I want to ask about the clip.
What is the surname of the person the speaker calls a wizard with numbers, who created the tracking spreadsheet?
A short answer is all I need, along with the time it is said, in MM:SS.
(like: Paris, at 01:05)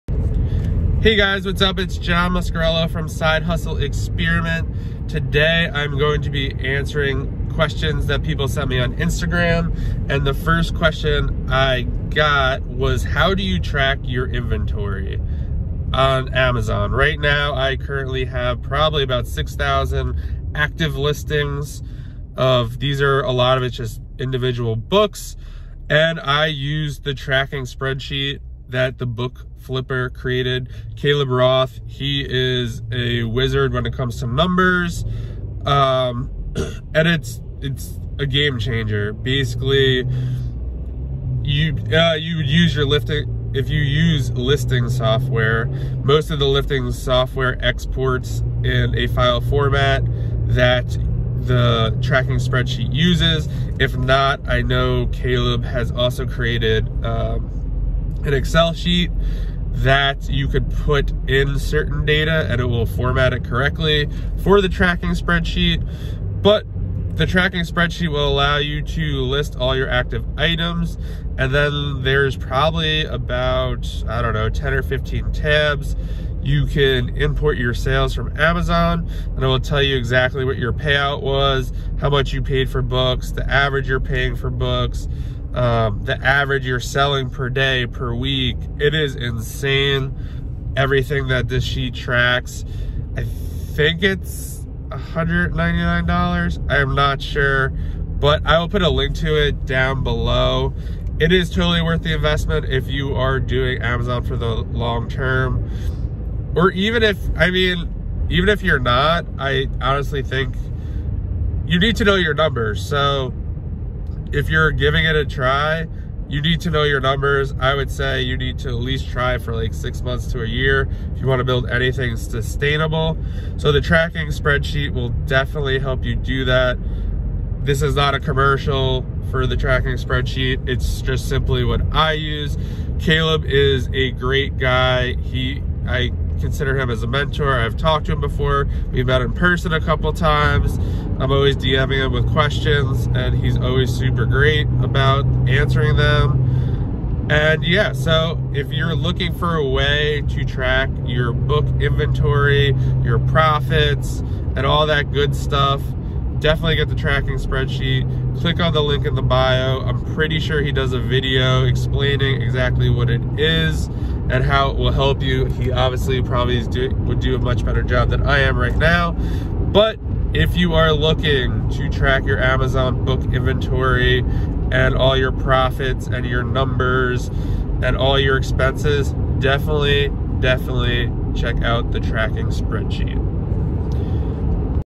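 Roth, at 00:31.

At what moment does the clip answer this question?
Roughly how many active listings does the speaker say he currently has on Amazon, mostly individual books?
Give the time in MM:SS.
00:19.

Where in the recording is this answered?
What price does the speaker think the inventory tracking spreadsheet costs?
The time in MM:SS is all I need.
01:34.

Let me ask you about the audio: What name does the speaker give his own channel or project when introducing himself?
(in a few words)
Side Hustle Experiment.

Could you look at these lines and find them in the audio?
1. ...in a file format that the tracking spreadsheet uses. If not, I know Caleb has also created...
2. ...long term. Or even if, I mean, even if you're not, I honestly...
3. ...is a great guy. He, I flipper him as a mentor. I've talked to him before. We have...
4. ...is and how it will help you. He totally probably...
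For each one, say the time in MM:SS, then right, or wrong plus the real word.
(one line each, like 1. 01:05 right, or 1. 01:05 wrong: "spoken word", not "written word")
1. 00:48 right
2. 01:44 right
3. 02:13 wrong: "consider", not "flipper"
4. 02:43 wrong: "obviously", not "totally".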